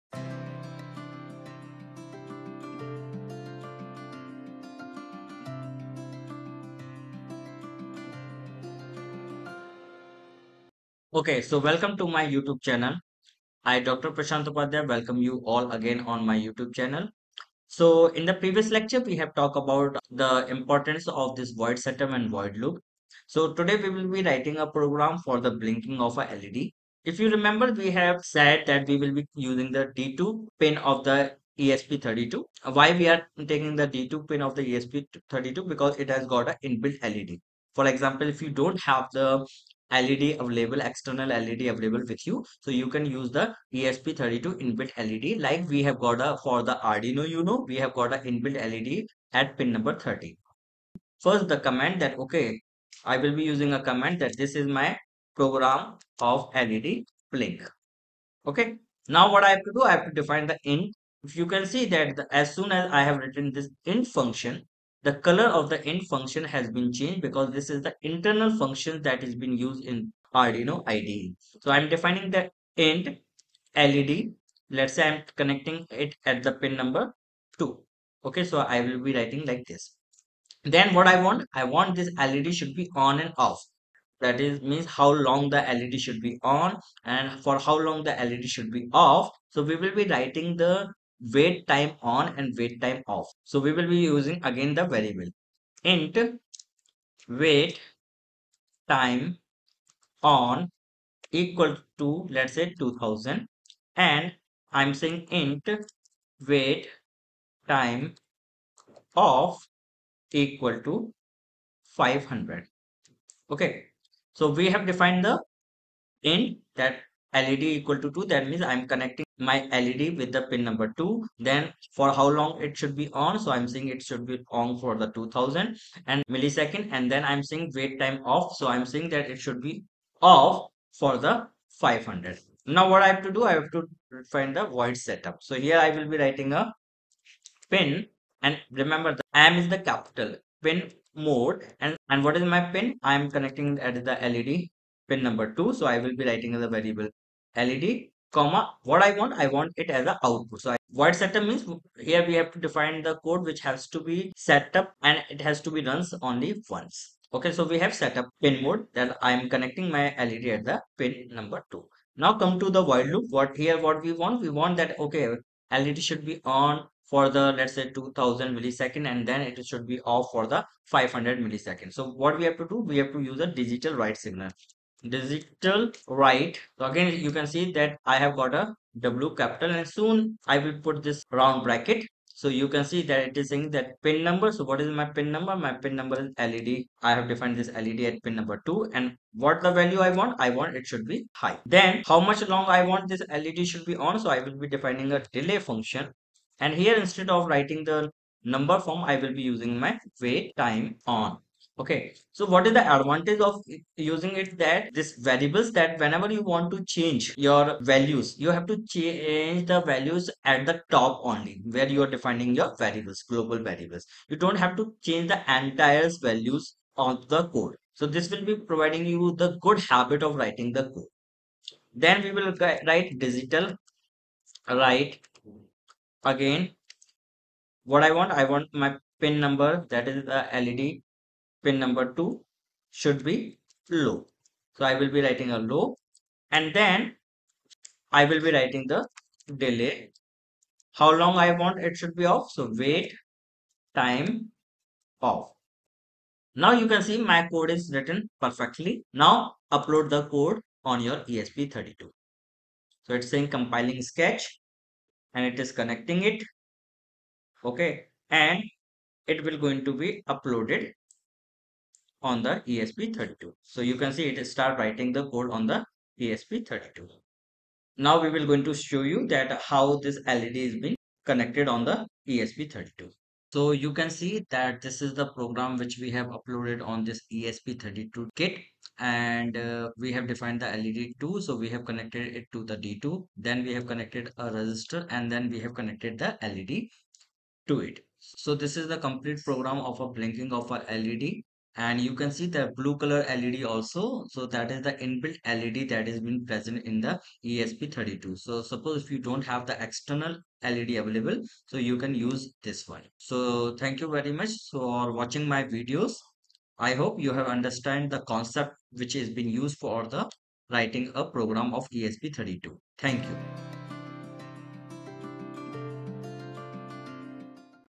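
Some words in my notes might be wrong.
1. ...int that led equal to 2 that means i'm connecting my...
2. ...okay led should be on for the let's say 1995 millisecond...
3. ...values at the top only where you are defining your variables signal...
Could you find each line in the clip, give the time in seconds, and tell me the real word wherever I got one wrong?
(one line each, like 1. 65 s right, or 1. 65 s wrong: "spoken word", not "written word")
1. 116 s right
2. 165 s wrong: "2000", not "1995"
3. 209 s wrong: "global", not "signal".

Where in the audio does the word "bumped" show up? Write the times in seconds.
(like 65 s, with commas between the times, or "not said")
not said.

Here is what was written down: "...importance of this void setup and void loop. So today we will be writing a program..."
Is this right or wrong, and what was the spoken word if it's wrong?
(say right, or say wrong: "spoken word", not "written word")
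right.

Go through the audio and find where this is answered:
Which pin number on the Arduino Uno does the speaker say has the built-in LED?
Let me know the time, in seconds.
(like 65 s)
49 s.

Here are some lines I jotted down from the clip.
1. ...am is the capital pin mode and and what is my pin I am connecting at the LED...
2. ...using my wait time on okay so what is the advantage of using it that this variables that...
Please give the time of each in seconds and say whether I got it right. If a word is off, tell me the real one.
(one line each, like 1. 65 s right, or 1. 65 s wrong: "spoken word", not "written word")
1. 139 s right
2. 199 s right.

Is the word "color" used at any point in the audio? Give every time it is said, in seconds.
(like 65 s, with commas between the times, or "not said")
65 s, 292 s.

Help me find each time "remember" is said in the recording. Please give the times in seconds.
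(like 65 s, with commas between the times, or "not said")
27 s, 138 s.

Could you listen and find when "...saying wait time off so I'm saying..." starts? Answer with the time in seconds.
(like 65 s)
127 s.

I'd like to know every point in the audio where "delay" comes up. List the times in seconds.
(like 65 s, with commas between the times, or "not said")
195 s, 239 s.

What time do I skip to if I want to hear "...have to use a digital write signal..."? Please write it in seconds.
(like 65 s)
173 s.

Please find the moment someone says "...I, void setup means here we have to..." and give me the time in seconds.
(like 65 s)
150 s.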